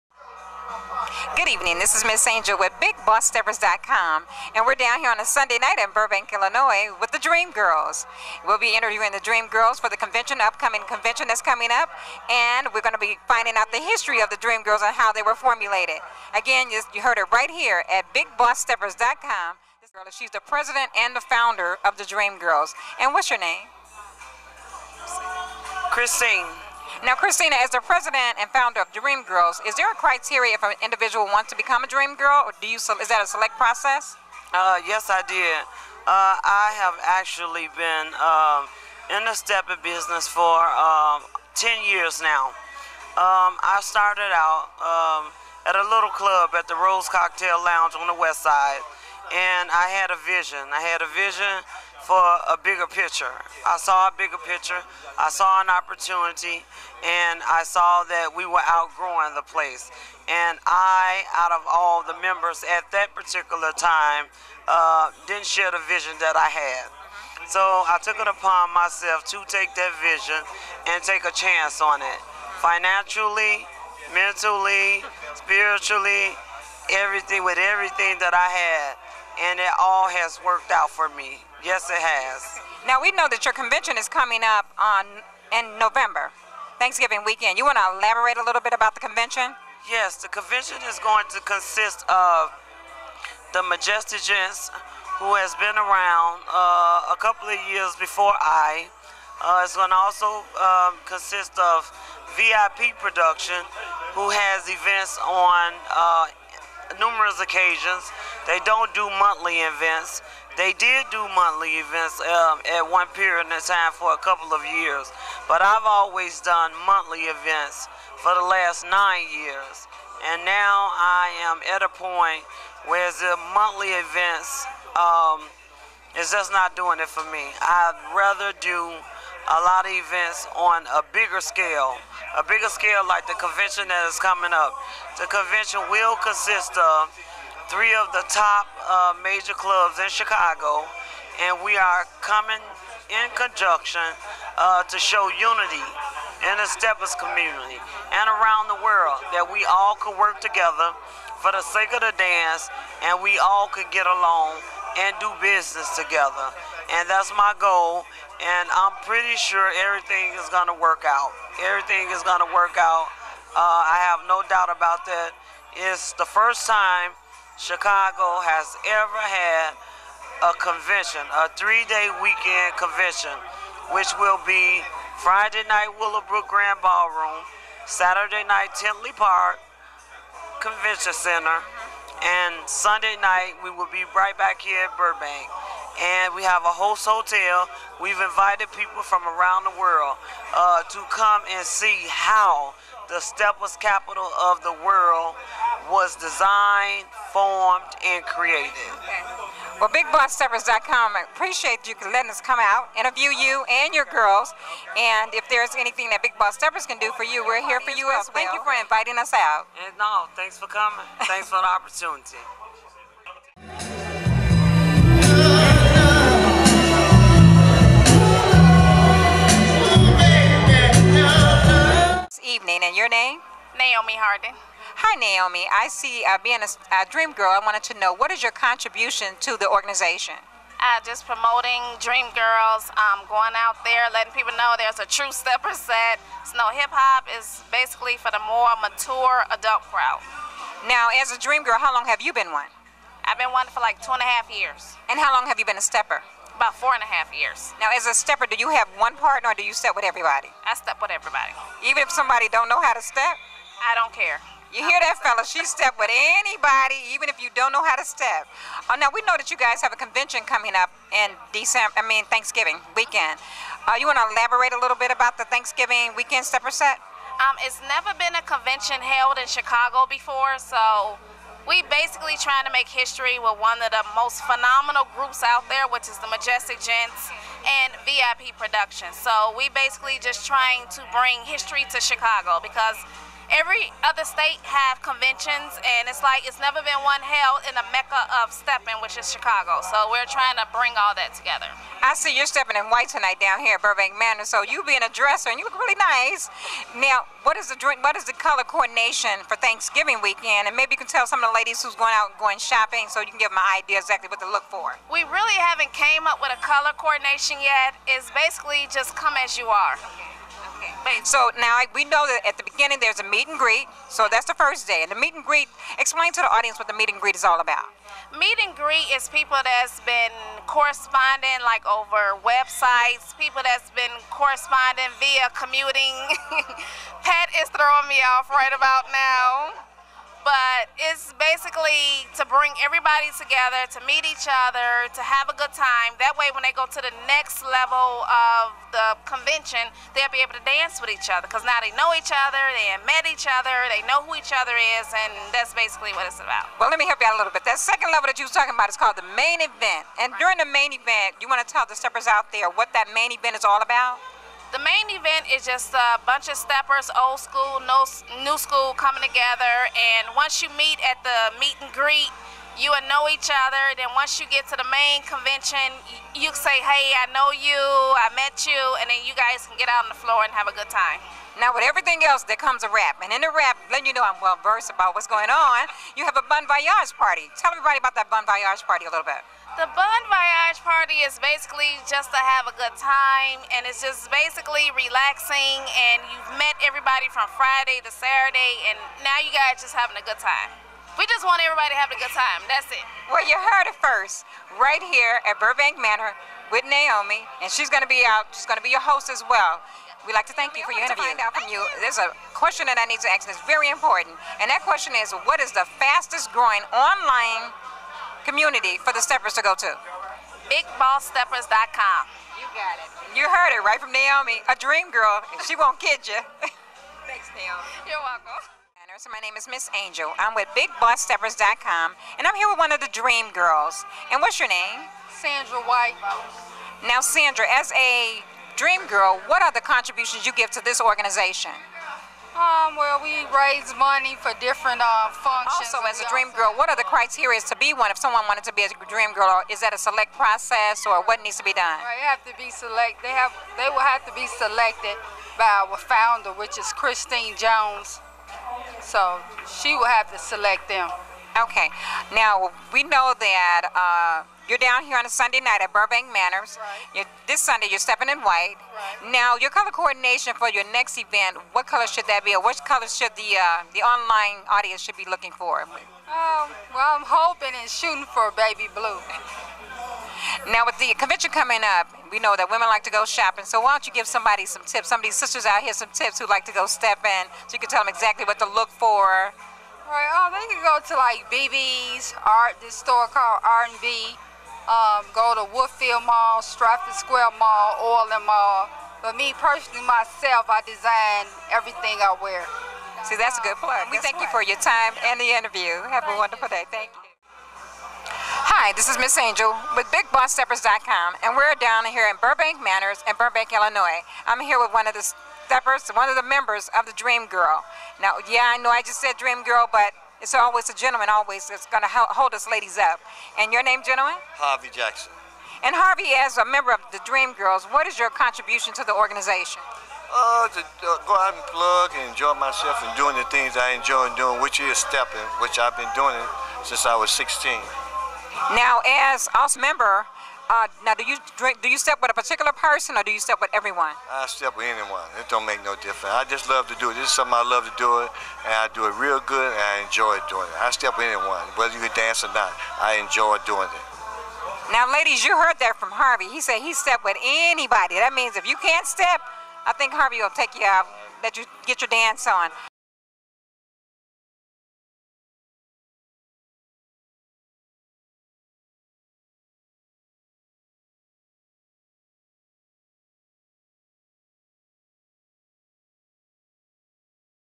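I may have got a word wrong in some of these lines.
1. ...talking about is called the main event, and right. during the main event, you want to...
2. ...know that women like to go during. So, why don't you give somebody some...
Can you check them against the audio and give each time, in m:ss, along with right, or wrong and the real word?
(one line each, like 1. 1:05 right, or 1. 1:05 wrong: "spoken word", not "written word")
1. 5:48 right
2. 7:52 wrong: "shopping", not "during".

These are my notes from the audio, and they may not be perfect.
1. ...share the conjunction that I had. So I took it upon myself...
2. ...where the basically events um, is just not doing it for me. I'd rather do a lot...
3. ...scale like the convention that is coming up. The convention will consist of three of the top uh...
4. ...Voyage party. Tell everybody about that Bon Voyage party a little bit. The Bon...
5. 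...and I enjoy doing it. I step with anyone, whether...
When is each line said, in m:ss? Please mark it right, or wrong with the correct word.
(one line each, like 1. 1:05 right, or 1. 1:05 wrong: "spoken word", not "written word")
1. 1:05 wrong: "vision", not "conjunction"
2. 2:02 wrong: "monthly", not "basically"
3. 2:12 right
4. 6:16 right
5. 8:59 right.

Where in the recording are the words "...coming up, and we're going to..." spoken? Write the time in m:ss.
0:11.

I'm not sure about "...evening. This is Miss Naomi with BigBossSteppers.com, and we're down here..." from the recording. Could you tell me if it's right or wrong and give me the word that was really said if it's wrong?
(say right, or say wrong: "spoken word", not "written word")
wrong: "Angel", not "Naomi".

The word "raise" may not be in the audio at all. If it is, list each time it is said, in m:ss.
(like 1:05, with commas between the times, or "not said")
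7:13.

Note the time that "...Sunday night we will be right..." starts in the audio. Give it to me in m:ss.
3:02.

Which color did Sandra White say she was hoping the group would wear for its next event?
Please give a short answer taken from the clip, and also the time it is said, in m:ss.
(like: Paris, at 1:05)
Baby blue, at 7:48.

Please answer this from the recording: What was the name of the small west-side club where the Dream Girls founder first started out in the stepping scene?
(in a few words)
Rose Cocktail Lounge.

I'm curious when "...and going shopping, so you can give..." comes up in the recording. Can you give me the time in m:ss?
5:02.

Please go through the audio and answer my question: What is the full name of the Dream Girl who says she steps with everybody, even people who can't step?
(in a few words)
Naomi Hardin.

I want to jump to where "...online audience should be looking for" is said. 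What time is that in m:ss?
7:43.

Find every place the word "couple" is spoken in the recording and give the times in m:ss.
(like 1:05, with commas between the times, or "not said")
1:37, 1:54.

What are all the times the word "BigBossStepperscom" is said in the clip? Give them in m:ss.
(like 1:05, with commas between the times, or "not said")
0:02, 0:18, 6:50, 7:00, 8:20.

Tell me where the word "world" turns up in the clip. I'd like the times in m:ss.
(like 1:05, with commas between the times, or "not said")
2:28, 3:09, 3:14.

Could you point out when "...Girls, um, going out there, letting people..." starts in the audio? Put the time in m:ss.
3:52.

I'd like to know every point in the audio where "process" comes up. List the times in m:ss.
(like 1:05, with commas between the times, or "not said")
0:33, 7:20.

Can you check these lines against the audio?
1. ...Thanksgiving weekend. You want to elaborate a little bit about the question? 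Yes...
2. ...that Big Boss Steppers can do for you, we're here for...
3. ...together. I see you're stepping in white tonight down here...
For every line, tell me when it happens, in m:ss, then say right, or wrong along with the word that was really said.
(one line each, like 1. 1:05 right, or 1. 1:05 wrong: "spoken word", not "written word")
1. 1:26 wrong: "convention", not "question"
2. 3:26 right
3. 4:51 right.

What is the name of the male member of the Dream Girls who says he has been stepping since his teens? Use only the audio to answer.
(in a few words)
Harvey Jackson.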